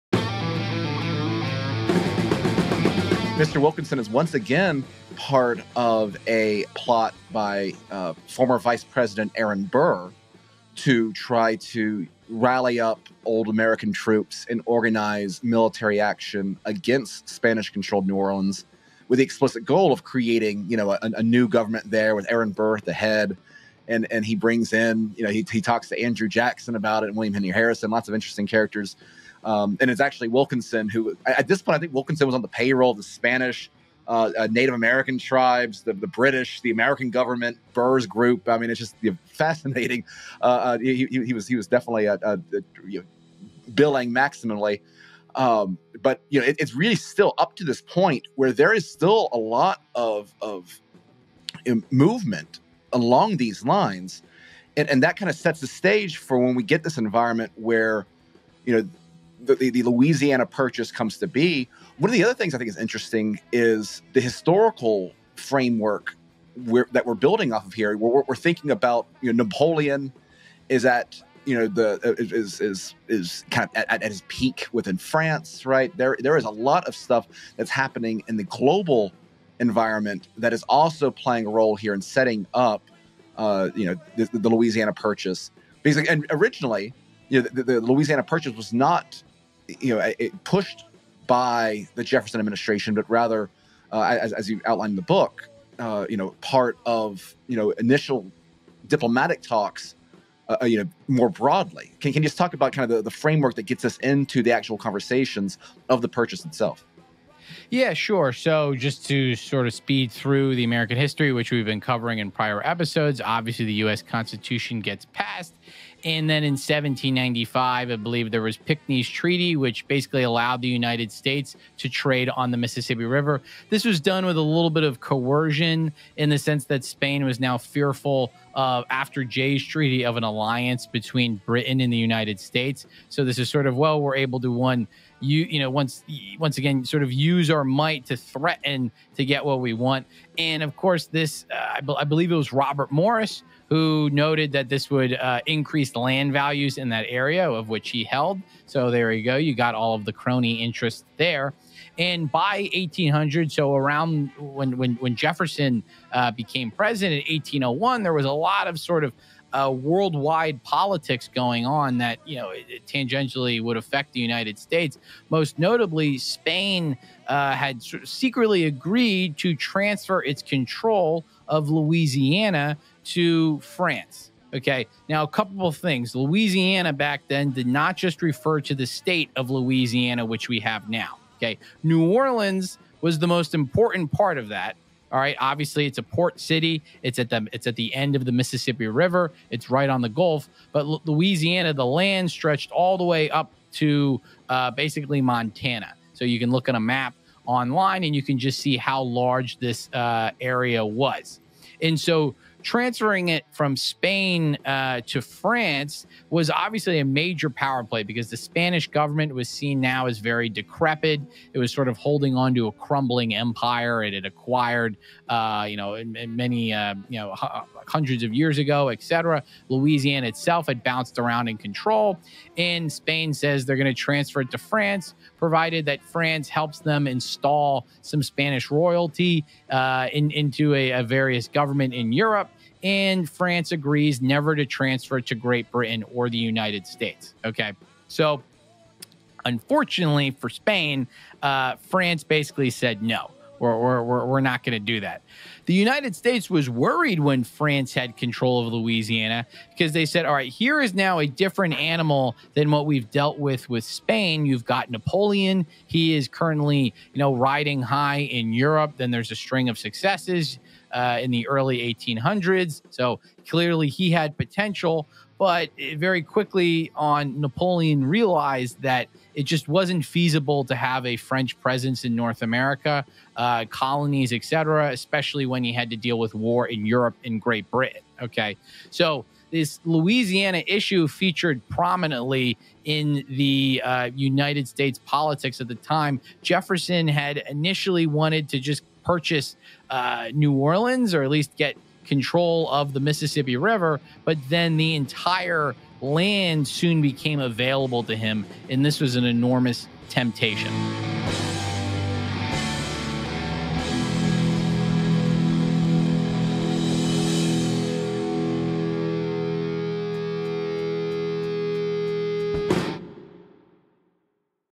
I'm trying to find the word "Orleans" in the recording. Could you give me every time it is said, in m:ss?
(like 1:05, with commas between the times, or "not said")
0:18, 3:02, 4:50.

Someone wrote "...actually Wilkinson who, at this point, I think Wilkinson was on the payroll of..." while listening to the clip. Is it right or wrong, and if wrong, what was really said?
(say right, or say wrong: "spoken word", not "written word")
right.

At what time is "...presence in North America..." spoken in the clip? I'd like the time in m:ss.
4:31.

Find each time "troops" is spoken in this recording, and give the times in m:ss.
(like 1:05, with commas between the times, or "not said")
0:13.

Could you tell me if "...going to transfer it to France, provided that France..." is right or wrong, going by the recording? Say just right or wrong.
right.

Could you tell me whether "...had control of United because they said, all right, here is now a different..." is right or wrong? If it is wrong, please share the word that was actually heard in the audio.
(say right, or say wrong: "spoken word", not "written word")
wrong: "Louisiana", not "United".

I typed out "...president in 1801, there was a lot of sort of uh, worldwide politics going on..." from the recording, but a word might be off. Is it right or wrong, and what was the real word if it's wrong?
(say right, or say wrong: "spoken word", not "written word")
right.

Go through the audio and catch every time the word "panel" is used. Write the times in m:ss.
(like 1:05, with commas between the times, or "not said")
not said.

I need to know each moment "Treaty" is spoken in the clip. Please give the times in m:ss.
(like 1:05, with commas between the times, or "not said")
1:59, 2:09.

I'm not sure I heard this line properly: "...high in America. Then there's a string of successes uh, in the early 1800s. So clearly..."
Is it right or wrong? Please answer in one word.
wrong.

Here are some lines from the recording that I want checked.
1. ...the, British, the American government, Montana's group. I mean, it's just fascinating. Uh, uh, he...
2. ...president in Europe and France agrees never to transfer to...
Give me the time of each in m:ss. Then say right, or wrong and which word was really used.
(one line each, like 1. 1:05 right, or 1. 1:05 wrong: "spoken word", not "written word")
1. 0:35 wrong: "Burr", not "Montana"
2. 3:51 wrong: "government", not "president".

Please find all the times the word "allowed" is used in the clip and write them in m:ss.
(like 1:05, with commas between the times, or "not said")
2:00.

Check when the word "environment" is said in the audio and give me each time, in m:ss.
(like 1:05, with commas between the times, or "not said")
0:56, 1:19.